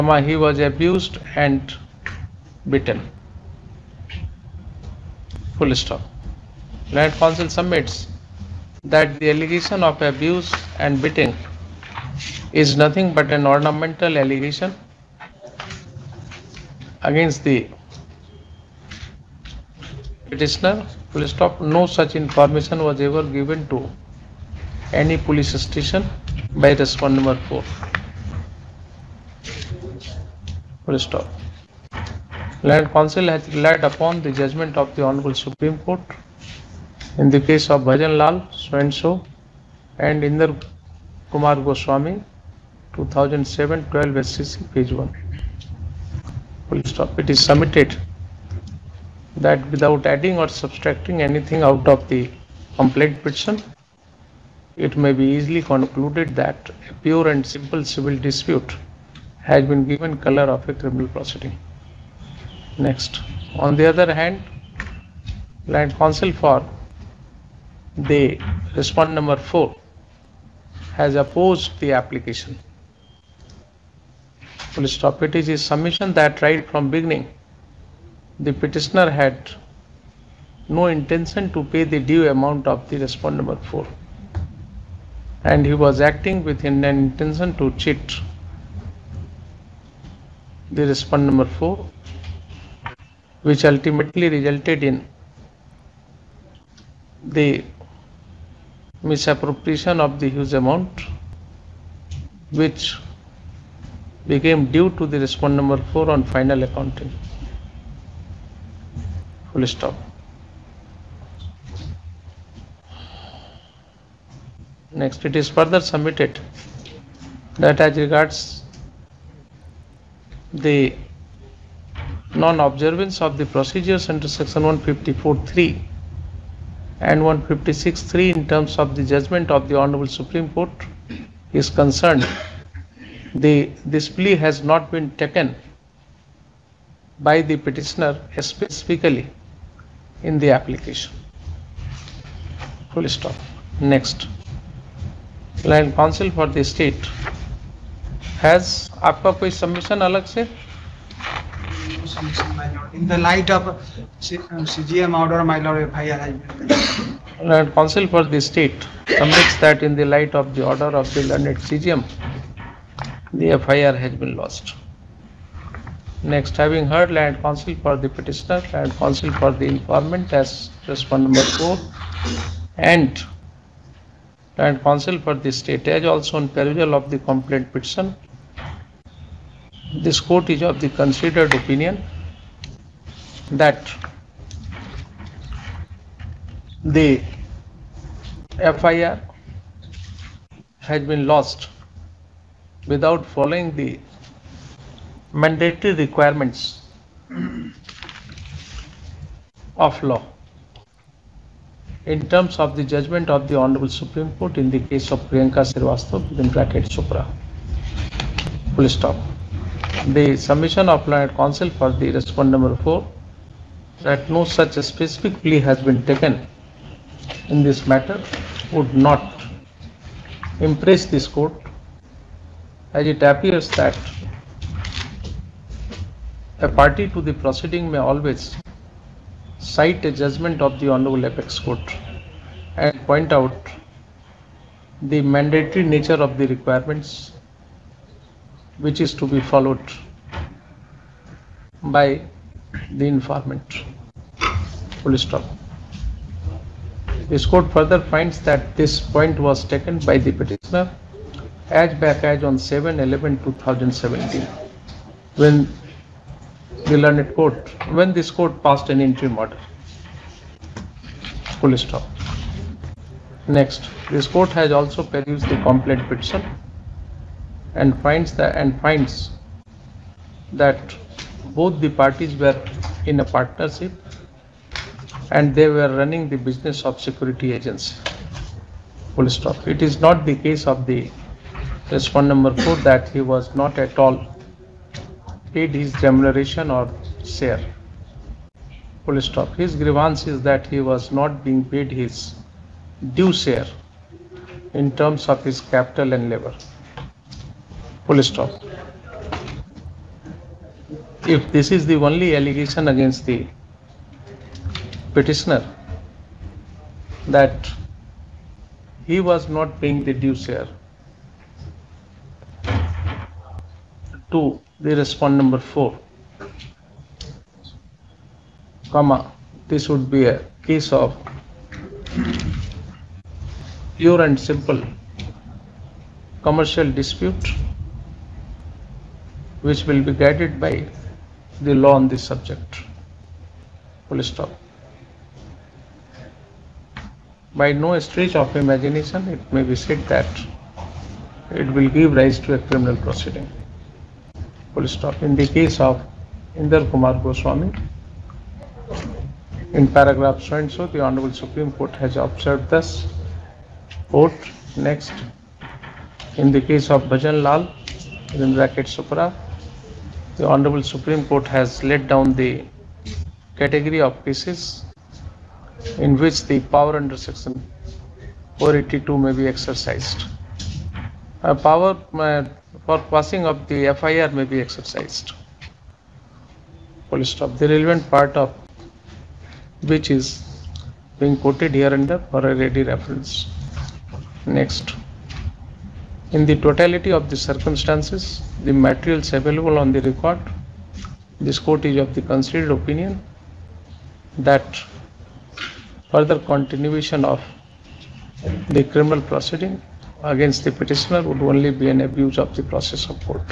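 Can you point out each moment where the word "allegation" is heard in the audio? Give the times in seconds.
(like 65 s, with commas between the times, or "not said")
9 s, 14 s, 302 s.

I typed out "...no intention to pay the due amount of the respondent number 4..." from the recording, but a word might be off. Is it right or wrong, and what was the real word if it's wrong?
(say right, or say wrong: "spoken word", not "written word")
right.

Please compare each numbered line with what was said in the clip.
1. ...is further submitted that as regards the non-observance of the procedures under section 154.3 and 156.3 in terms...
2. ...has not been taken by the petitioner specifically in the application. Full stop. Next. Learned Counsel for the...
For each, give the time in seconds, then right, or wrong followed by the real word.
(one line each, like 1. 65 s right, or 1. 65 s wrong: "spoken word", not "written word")
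1. 115 s right
2. 134 s right.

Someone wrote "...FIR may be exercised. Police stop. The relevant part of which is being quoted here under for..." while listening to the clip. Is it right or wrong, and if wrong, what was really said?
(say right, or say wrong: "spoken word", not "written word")
right.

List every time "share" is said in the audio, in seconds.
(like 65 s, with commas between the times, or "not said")
287 s, 293 s, 310 s.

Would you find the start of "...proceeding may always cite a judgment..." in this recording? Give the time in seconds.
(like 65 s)
227 s.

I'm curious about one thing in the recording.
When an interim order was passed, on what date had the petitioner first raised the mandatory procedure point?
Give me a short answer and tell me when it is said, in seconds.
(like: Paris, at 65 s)
7/11/2017, at 252 s.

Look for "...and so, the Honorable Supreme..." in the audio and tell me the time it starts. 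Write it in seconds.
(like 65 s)
350 s.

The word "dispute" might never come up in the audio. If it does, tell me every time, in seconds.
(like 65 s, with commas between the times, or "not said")
58 s, 326 s.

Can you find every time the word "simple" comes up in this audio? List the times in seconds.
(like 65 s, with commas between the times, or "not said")
57 s, 324 s.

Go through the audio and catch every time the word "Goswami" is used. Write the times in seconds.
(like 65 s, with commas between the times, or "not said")
41 s, 347 s.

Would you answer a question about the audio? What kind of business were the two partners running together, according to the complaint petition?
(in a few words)
security agency.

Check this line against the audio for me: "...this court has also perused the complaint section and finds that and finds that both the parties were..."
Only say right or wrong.
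wrong.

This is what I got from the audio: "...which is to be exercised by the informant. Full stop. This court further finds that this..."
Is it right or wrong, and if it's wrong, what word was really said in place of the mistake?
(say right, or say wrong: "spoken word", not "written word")
wrong: "followed", not "exercised".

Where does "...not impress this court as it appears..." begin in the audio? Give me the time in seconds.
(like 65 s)
218 s.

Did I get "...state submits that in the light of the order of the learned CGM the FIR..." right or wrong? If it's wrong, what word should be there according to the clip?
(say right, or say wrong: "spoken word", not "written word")
right.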